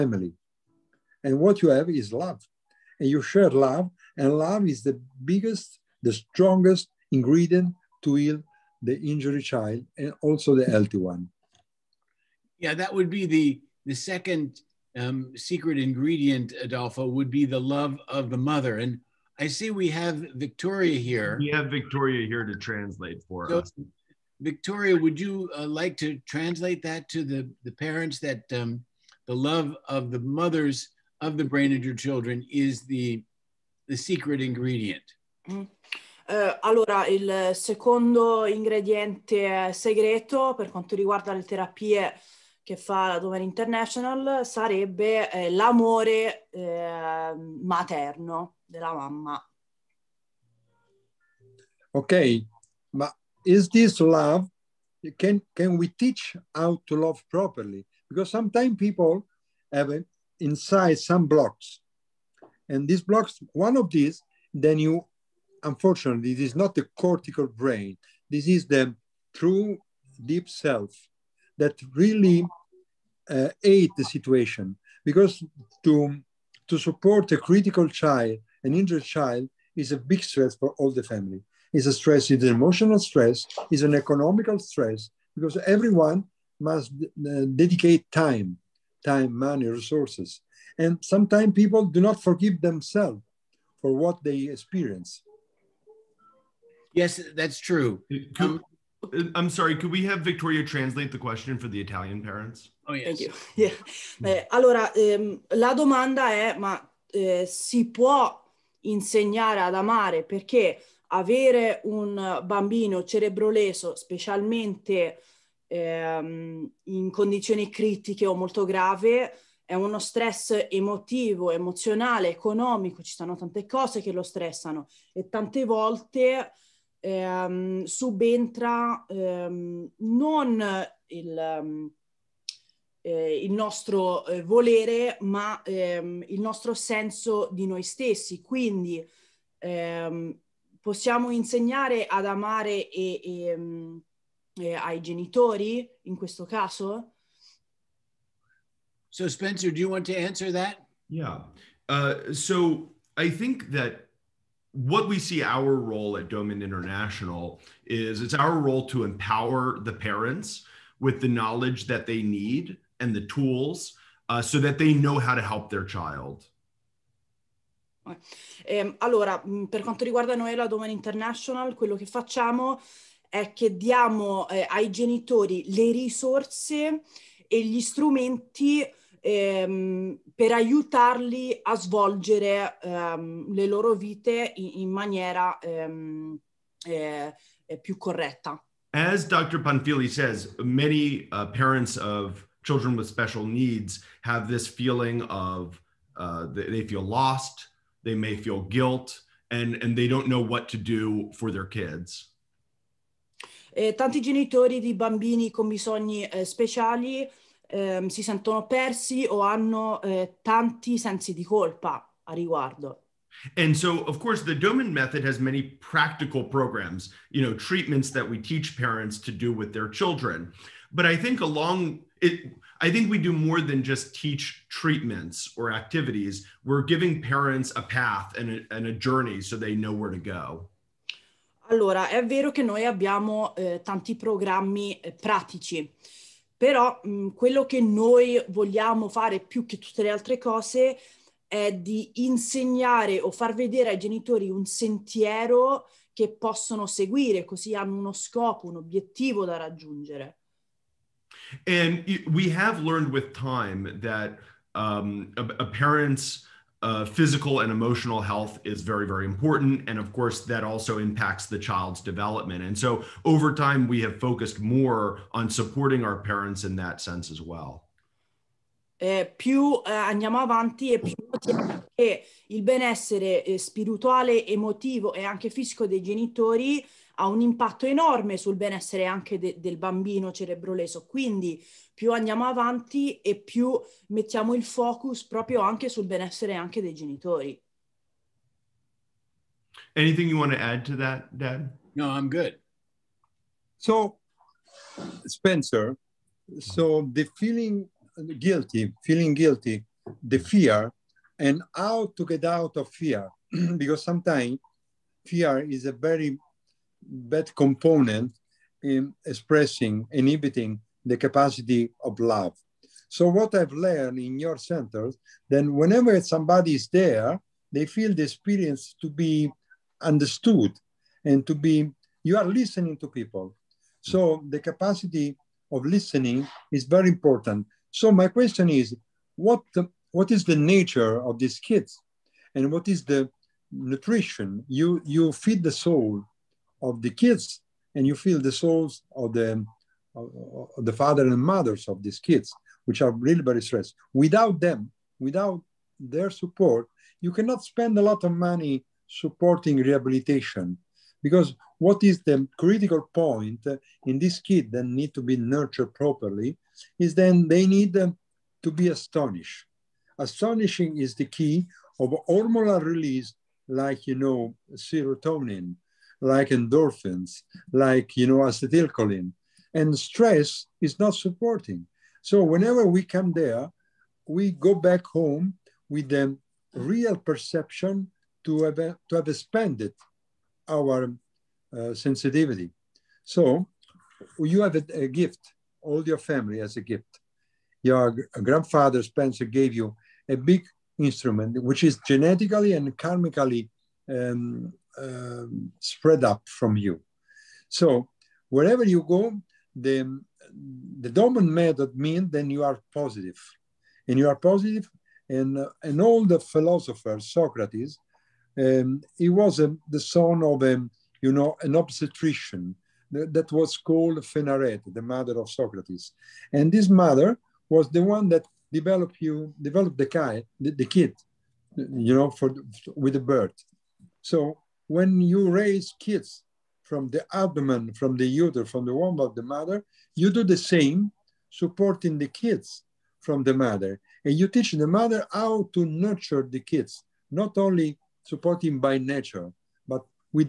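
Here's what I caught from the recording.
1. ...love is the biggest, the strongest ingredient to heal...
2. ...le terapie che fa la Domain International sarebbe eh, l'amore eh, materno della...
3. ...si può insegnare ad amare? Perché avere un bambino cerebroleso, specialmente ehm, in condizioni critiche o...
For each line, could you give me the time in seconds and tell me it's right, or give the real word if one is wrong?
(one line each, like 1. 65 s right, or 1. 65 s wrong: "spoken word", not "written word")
1. 4 s right
2. 41 s right
3. 107 s right.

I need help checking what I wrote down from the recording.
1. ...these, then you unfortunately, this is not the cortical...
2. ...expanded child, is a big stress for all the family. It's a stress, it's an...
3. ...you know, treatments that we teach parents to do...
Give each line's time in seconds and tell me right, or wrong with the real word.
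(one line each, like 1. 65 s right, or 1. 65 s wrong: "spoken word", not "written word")
1. 63 s right
2. 78 s wrong: "injured", not "expanded"
3. 217 s right.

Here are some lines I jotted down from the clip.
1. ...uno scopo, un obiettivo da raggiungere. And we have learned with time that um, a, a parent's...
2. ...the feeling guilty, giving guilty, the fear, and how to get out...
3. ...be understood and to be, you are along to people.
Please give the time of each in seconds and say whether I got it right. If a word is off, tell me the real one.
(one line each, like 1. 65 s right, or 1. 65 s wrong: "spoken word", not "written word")
1. 247 s right
2. 297 s wrong: "feeling", not "giving"
3. 319 s wrong: "listening", not "along".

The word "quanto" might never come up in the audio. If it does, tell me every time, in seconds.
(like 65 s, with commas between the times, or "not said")
40 s, 169 s.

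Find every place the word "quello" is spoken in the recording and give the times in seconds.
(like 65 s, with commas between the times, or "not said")
171 s, 237 s.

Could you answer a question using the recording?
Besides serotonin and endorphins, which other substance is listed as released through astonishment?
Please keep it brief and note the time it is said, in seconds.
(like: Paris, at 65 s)
acetylcholine, at 368 s.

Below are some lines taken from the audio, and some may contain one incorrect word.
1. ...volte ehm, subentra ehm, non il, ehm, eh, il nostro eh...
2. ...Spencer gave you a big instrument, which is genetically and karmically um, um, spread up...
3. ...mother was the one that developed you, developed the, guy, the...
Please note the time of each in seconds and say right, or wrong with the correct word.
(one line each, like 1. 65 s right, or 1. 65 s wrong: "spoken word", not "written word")
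1. 125 s right
2. 389 s right
3. 416 s right.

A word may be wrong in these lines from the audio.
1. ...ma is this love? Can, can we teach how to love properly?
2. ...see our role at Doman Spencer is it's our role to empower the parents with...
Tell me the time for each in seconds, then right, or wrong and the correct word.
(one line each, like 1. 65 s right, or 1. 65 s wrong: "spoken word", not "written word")
1. 52 s right
2. 155 s wrong: "International", not "Spencer".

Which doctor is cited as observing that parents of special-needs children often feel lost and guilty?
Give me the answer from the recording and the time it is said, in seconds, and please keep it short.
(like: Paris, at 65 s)
Dr. Panfili, at 189 s.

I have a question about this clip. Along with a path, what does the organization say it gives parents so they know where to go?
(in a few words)
a journey.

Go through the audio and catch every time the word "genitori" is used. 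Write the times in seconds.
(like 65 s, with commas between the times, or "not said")
145 s, 174 s, 204 s, 243 s, 276 s, 286 s.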